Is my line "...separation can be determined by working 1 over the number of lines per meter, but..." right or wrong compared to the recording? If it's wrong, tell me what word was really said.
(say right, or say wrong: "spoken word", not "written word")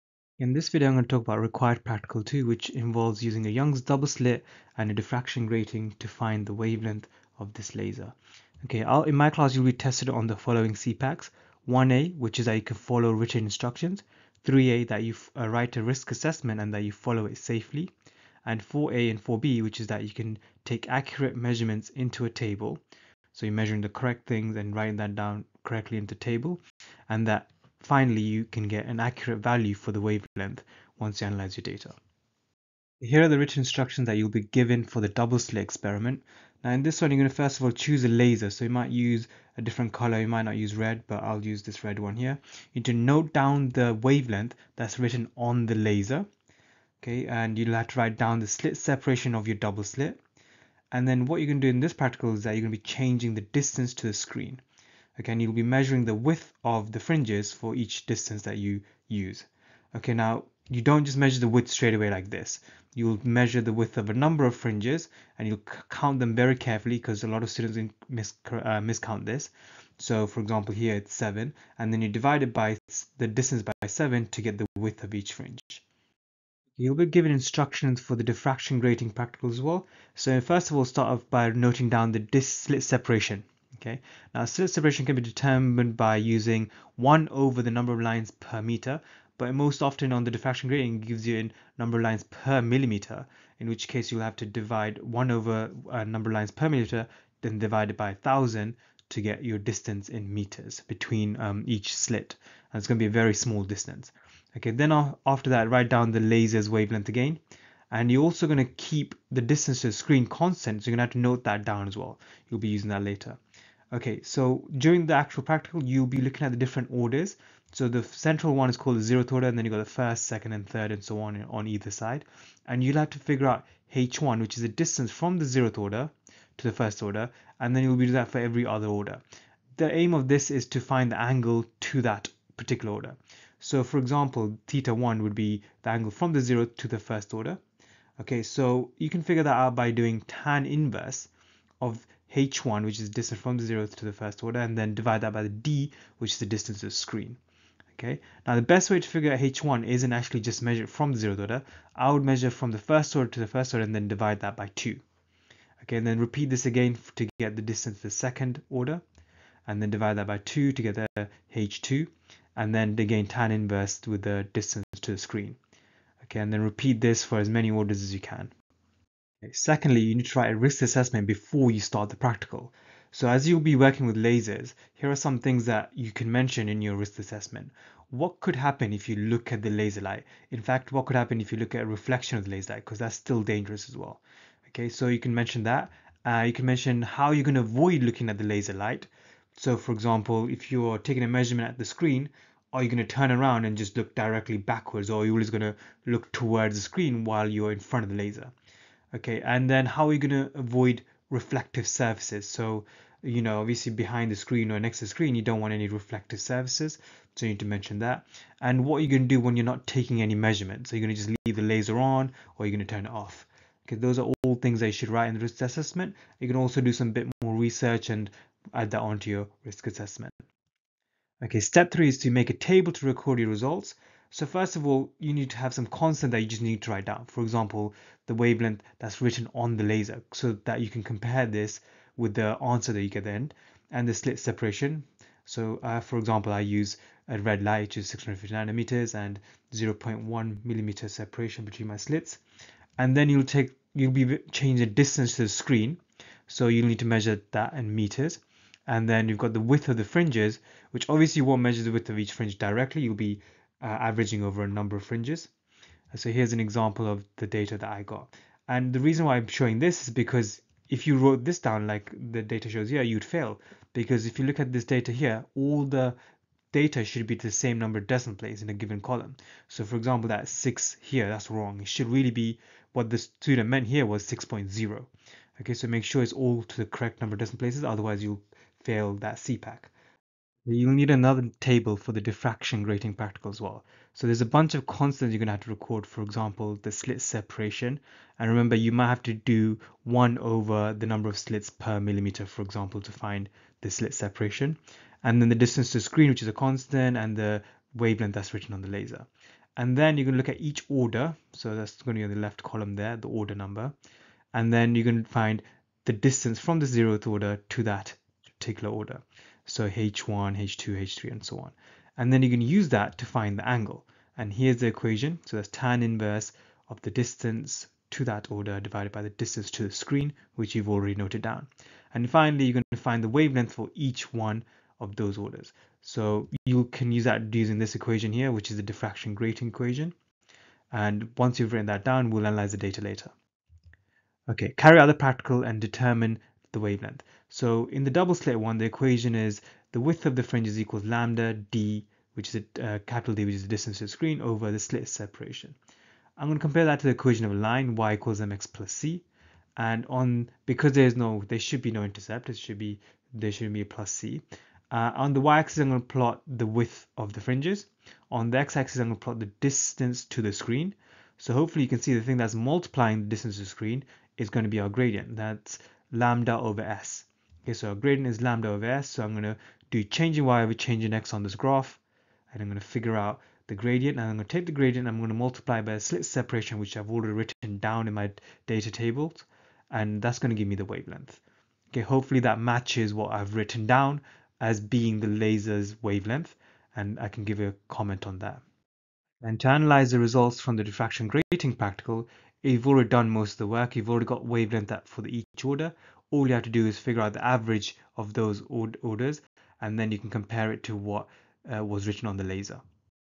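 wrong: "using", not "working".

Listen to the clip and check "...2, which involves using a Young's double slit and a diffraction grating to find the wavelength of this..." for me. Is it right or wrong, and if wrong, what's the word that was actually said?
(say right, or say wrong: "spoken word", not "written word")
right.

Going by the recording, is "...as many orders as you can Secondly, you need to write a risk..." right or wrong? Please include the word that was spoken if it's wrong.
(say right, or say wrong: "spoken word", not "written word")
right.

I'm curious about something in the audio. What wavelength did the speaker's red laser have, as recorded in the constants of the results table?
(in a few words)
650 nanometers.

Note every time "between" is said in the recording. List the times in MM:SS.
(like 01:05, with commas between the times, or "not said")
01:40, 04:01.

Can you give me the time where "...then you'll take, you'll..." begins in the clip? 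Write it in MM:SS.
04:03.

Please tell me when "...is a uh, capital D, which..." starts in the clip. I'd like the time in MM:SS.
05:42.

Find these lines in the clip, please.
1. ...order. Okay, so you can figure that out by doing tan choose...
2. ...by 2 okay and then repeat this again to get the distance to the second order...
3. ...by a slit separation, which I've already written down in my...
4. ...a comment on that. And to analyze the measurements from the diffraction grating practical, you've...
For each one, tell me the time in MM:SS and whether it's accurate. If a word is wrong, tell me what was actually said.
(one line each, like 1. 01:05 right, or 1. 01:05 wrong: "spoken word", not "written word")
1. 02:17 wrong: "inverse", not "choose"
2. 02:34 right
3. 06:15 right
4. 06:27 wrong: "results", not "measurements".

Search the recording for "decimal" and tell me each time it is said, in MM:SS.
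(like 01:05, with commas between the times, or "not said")
04:28, 04:37.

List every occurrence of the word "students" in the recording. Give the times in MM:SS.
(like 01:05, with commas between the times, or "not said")
01:07, 04:33.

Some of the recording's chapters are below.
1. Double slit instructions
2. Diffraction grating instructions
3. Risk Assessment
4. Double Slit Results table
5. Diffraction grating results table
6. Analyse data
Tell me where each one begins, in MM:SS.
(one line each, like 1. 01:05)
1. 00:33
2. 01:15
3. 02:49
4. 03:40
5. 04:40
6. 05:34.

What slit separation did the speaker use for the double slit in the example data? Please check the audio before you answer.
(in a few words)
0.1 millimeter.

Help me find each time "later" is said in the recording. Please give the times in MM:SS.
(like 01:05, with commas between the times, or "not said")
01:53, 05:33.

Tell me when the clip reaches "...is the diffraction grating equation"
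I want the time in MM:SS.
05:28.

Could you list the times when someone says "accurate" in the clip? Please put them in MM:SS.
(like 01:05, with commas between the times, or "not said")
00:20, 00:28.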